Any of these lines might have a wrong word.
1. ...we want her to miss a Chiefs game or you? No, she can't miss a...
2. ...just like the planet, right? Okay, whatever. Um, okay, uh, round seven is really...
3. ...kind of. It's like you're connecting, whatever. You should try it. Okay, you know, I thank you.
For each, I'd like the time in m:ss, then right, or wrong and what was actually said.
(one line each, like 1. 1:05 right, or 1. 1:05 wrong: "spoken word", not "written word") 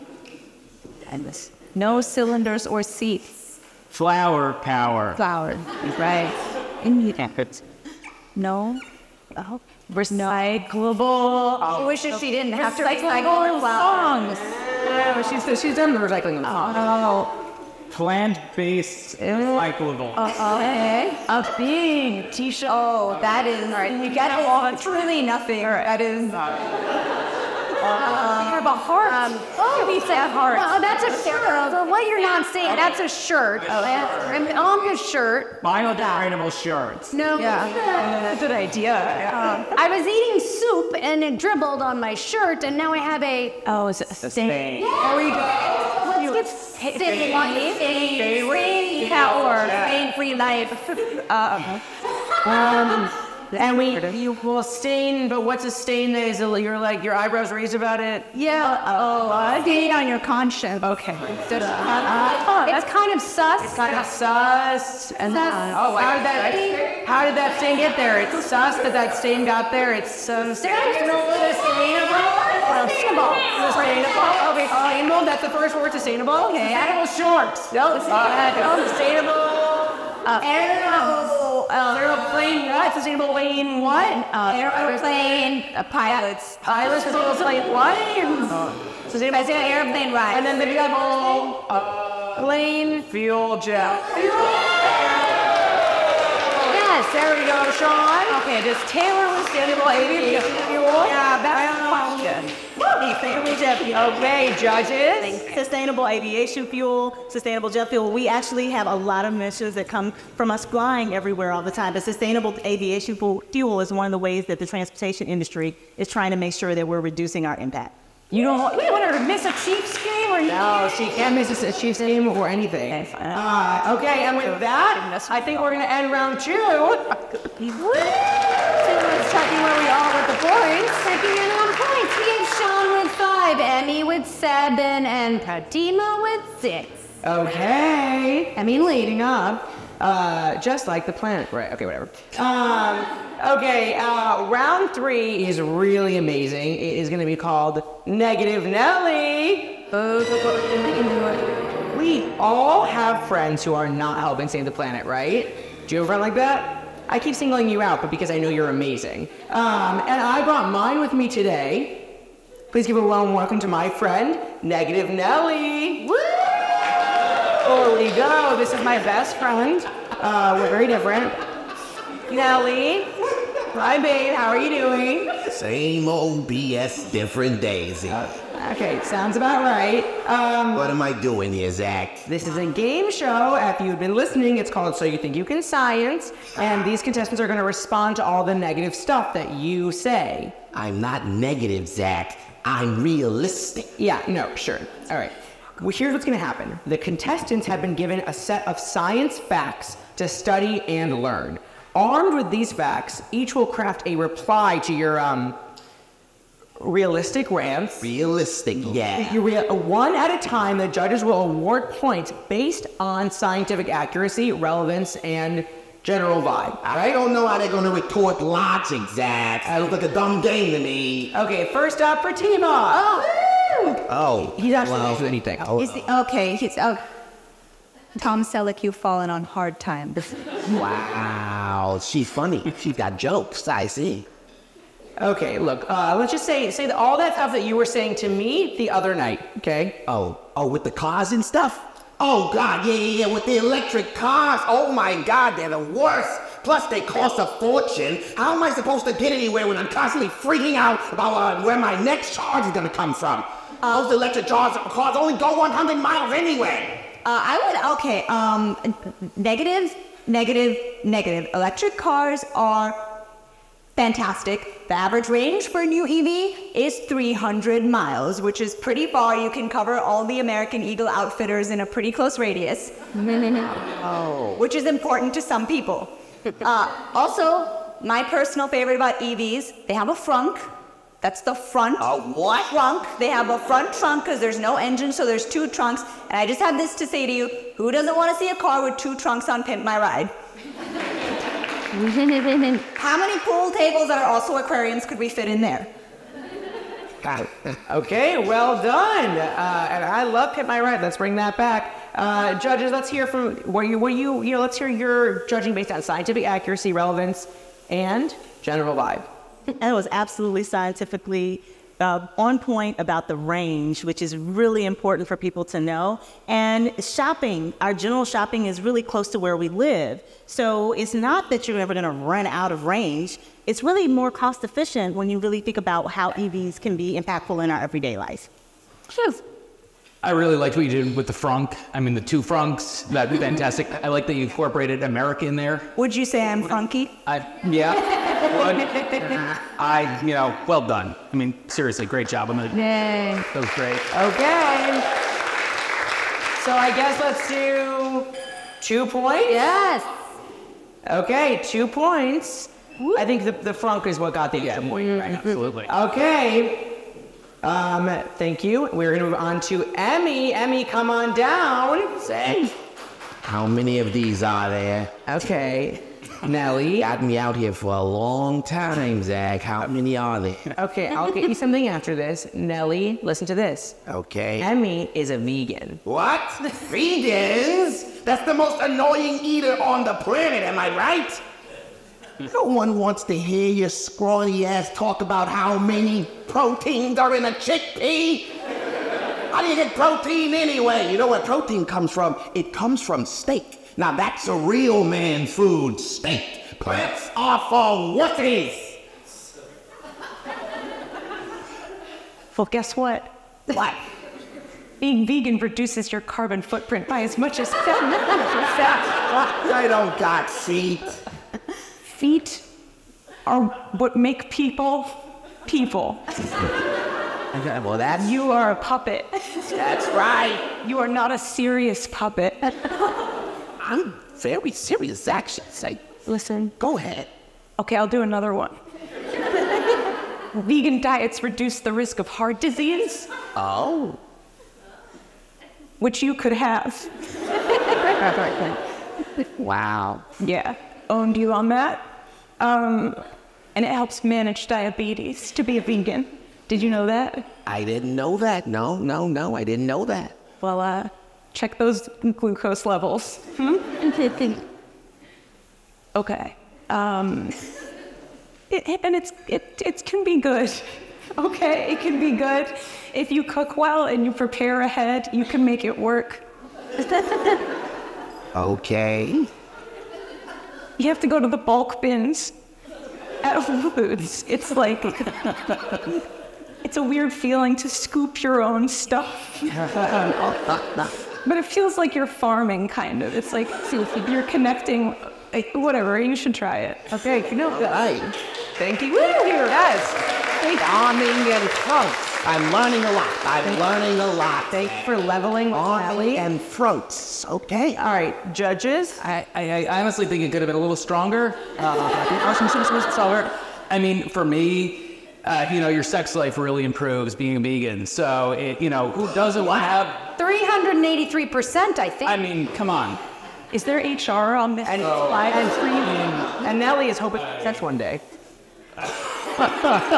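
1. 1:58 right
2. 2:20 wrong: "three", not "seven"
3. 8:02 right.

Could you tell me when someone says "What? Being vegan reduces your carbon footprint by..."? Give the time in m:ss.
6:43.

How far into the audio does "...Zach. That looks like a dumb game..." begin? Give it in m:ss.
3:39.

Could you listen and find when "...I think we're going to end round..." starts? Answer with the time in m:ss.
2:05.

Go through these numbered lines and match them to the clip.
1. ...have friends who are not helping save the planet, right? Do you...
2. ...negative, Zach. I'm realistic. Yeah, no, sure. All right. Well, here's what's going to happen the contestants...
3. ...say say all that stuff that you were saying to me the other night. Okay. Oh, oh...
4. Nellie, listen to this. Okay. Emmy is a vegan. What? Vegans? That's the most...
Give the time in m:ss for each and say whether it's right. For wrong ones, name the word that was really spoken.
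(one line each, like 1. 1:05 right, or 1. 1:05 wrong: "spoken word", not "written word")
1. 2:32 right
2. 3:11 right
3. 3:56 right
4. 6:12 right.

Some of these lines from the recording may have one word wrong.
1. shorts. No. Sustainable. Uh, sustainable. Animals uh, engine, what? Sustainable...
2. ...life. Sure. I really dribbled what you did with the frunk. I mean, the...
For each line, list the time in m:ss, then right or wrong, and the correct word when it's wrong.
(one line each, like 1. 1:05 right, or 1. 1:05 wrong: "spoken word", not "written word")
1. 1:17 wrong: "aeroplane", not "engine"
2. 5:28 wrong: "liked", not "dribbled".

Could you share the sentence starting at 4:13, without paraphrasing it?
Uh, Those electric cars, cars only go 100 miles anyway.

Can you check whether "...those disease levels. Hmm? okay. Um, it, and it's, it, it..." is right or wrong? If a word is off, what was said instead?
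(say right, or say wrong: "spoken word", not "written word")
wrong: "glucose", not "disease".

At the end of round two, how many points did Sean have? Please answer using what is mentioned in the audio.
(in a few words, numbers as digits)
5.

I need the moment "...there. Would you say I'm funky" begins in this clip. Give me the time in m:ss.
5:35.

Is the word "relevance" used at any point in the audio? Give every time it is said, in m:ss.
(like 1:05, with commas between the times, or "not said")
3:34, 5:06.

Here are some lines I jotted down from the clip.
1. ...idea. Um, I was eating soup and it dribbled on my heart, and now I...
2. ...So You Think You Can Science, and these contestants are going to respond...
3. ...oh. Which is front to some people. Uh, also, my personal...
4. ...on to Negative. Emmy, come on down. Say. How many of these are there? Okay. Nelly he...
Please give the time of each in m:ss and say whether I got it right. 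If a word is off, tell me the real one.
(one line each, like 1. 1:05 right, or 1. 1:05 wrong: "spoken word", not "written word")
1. 0:38 wrong: "shirt", not "heart"
2. 3:04 right
3. 4:33 wrong: "important", not "front"
4. 5:59 wrong: "Emmy", not "Negative".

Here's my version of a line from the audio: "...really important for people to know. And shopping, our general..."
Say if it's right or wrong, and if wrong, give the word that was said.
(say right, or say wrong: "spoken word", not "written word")
right.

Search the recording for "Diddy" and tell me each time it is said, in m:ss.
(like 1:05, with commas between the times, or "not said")
not said.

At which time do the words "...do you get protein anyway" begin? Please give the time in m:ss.
6:29.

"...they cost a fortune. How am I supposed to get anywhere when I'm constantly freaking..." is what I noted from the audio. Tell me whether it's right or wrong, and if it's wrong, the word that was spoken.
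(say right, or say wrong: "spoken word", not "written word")
right.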